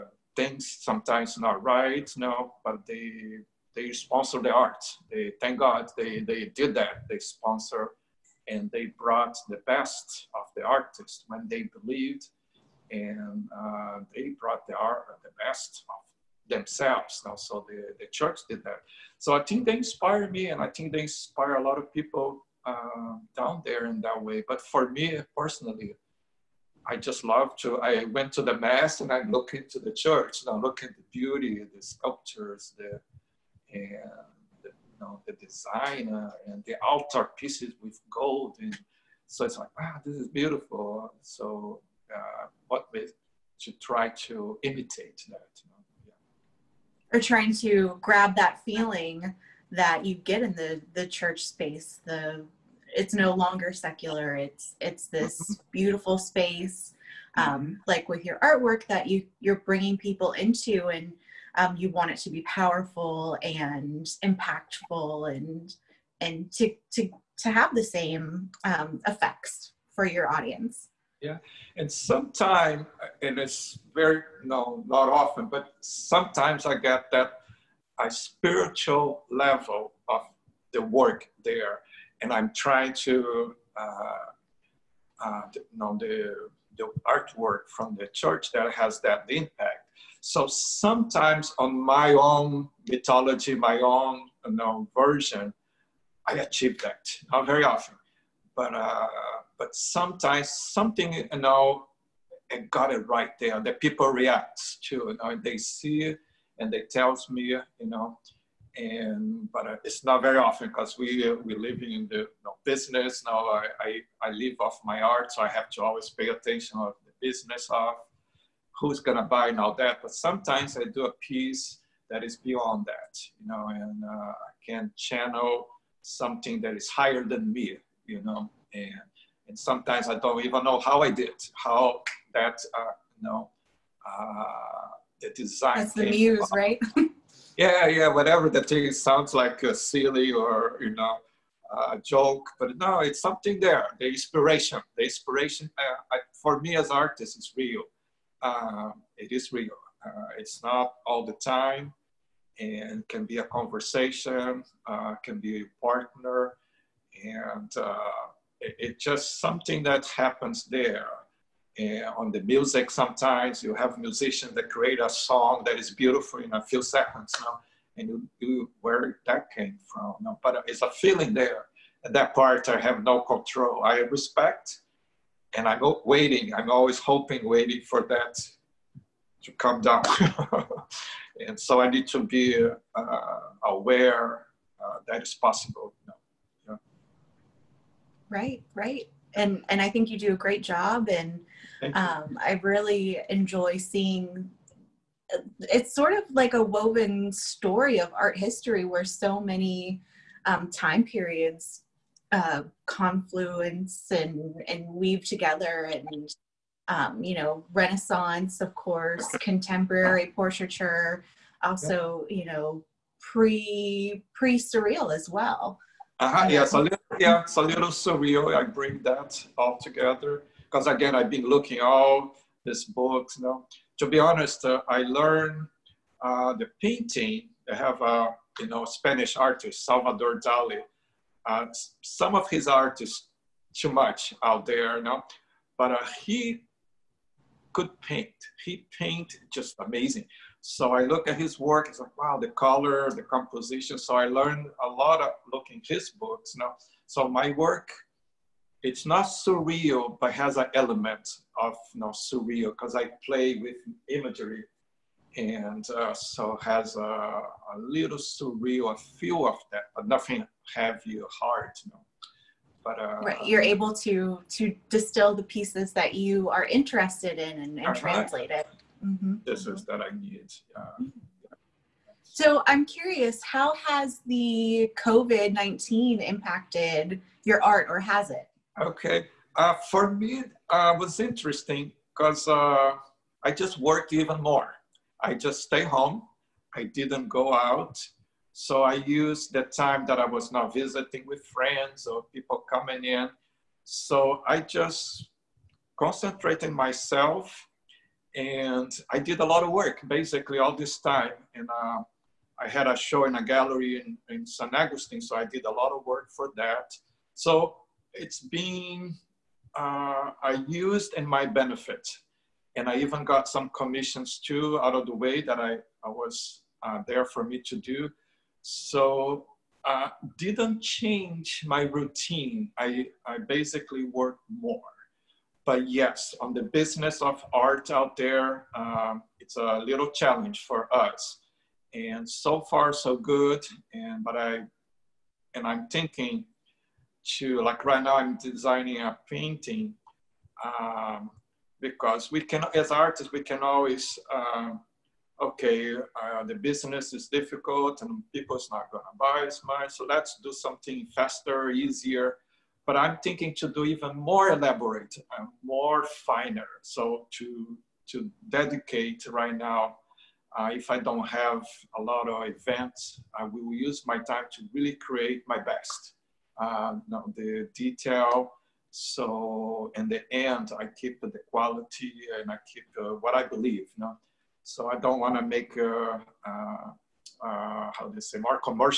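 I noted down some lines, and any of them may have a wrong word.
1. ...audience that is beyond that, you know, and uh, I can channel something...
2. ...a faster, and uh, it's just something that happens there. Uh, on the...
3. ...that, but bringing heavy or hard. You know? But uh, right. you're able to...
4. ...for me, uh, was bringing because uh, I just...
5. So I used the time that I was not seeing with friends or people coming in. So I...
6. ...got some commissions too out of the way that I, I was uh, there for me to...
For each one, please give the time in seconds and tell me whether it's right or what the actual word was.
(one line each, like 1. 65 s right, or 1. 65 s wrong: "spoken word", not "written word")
1. 121 s wrong: "piece", not "audience"
2. 155 s wrong: "partner", not "faster"
3. 259 s wrong: "nothing", not "bringing"
4. 279 s wrong: "interesting", not "bringing"
5. 288 s wrong: "visiting", not "seeing"
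6. 313 s right.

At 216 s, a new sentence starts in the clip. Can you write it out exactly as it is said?
yeah so um, yeah, it's a little surreal.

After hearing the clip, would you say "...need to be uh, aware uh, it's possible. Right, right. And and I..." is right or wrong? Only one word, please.
right.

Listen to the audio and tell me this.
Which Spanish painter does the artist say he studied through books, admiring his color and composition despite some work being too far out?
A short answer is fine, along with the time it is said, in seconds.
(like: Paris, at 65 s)
Salvador Dali, at 229 s.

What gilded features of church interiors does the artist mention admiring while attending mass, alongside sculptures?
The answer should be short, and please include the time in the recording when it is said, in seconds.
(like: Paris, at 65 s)
altar pieces, at 36 s.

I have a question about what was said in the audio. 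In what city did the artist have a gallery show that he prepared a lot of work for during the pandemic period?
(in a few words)
San Agustin.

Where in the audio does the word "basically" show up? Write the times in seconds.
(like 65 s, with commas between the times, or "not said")
300 s, 323 s.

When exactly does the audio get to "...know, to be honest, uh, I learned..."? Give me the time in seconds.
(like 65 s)
223 s.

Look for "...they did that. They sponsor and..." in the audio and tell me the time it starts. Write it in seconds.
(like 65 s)
6 s.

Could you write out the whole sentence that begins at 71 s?
And sometime, uh, and it's very, no, not often, but sometimes I get that a spiritual level of the work there.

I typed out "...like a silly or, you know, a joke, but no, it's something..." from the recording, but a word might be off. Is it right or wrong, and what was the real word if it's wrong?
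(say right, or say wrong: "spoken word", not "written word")
right.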